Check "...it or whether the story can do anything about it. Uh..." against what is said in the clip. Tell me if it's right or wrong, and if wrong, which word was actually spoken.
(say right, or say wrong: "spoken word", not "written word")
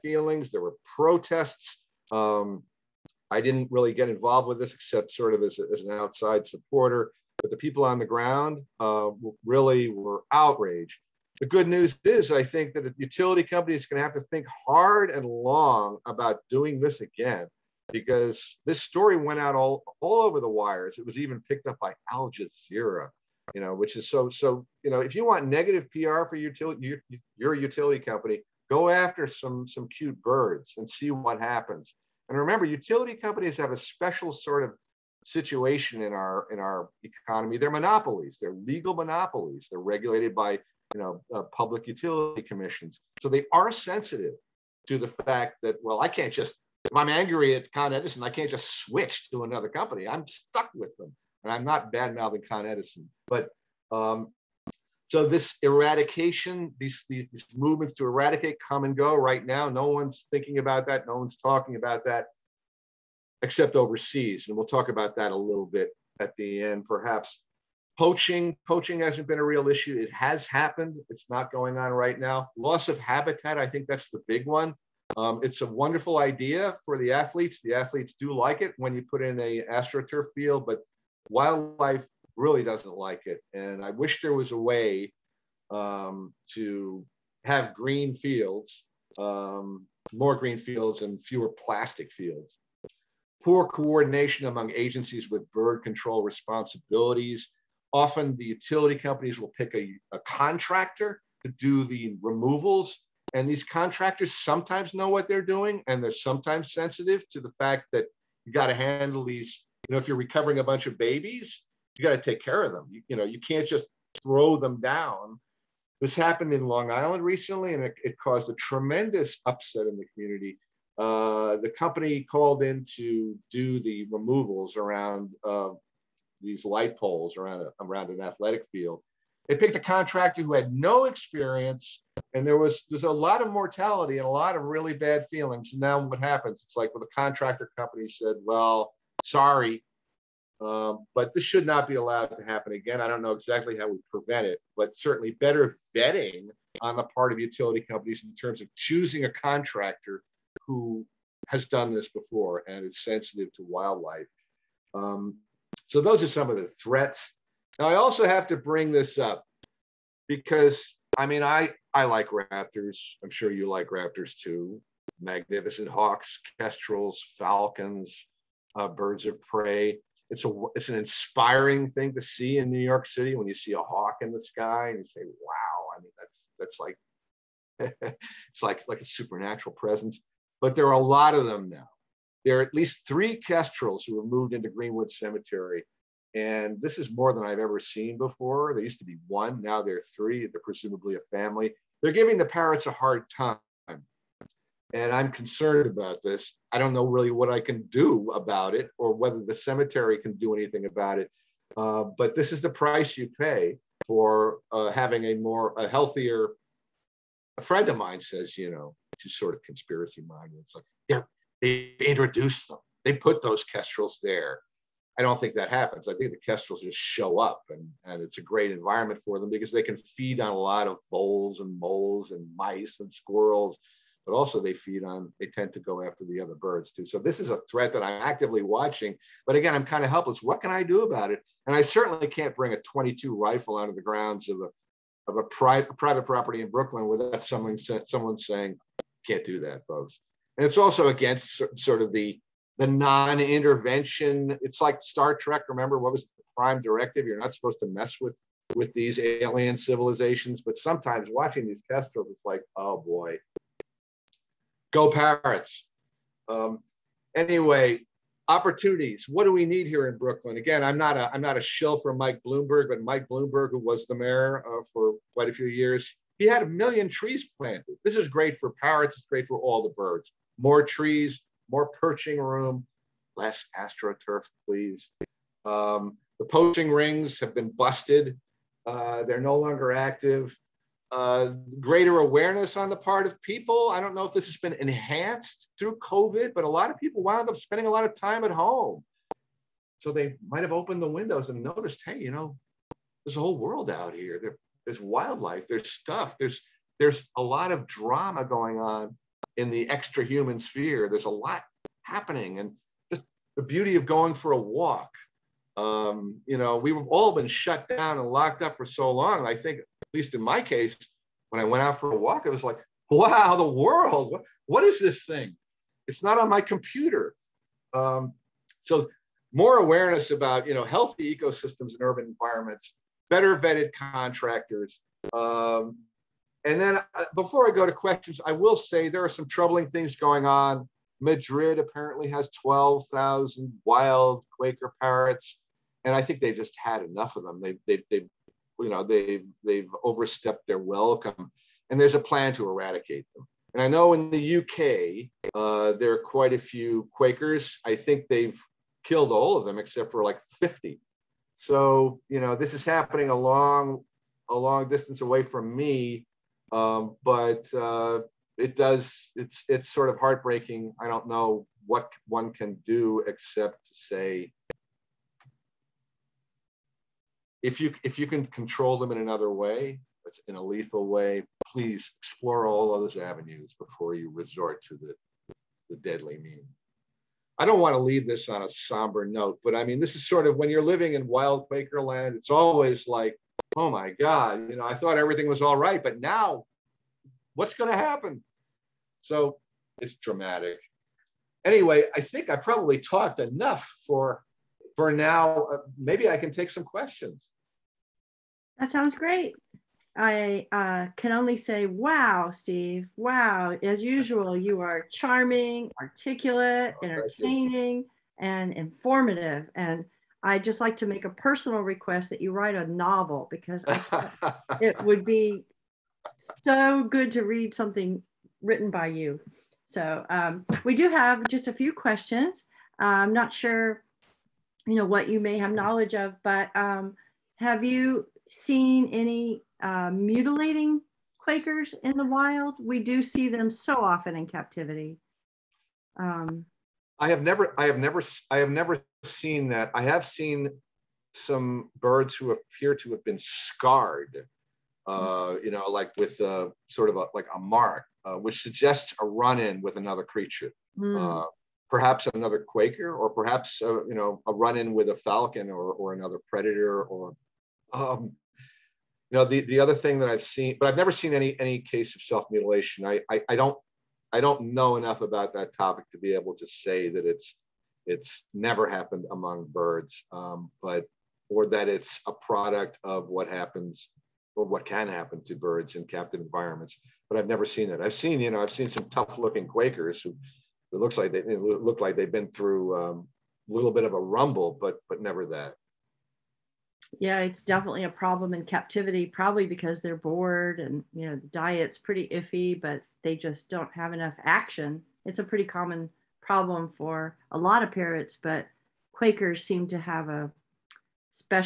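wrong: "cemetery", not "story".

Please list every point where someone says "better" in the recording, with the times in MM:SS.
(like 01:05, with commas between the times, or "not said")
02:25, 05:23.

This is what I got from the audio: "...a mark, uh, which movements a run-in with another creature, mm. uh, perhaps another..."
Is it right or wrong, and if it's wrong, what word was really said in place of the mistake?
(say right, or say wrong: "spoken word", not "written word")
wrong: "suggests", not "movements".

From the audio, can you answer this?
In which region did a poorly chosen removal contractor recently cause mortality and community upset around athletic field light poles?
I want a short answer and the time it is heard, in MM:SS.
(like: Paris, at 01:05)
Long Island, at 01:56.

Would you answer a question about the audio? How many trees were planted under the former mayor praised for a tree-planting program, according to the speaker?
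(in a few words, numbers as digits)
a million.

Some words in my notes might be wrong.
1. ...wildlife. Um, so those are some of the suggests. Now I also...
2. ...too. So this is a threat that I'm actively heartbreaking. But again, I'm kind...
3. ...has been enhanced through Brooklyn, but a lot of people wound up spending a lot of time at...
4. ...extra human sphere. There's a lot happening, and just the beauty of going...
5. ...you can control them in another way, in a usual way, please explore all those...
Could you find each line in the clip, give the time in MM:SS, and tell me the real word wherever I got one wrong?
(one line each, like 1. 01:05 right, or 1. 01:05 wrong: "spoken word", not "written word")
1. 02:33 wrong: "threats", not "suggests"
2. 03:46 wrong: "watching", not "heartbreaking"
3. 04:44 wrong: "COVID", not "Brooklyn"
4. 04:59 right
5. 06:08 wrong: "lethal", not "usual".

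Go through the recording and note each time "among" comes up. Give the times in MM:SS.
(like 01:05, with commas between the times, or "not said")
01:34, 07:49.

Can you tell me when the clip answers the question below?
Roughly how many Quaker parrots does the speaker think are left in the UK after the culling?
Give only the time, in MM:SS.
05:50.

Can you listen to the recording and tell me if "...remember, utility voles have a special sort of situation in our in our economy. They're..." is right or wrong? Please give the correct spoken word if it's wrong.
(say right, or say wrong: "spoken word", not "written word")
wrong: "companies", not "voles".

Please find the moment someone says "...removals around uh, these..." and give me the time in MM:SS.
02:04.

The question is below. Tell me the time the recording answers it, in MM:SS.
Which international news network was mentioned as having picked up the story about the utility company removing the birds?
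00:22.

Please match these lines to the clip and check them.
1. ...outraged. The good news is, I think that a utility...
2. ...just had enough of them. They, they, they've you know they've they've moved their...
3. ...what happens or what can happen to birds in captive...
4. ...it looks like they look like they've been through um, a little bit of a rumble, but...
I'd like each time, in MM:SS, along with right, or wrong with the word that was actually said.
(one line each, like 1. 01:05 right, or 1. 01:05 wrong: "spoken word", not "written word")
1. 00:10 right
2. 05:36 wrong: "overstepped", not "moved"
3. 07:53 right
4. 08:00 right.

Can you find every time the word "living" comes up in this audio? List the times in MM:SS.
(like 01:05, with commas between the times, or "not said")
06:20.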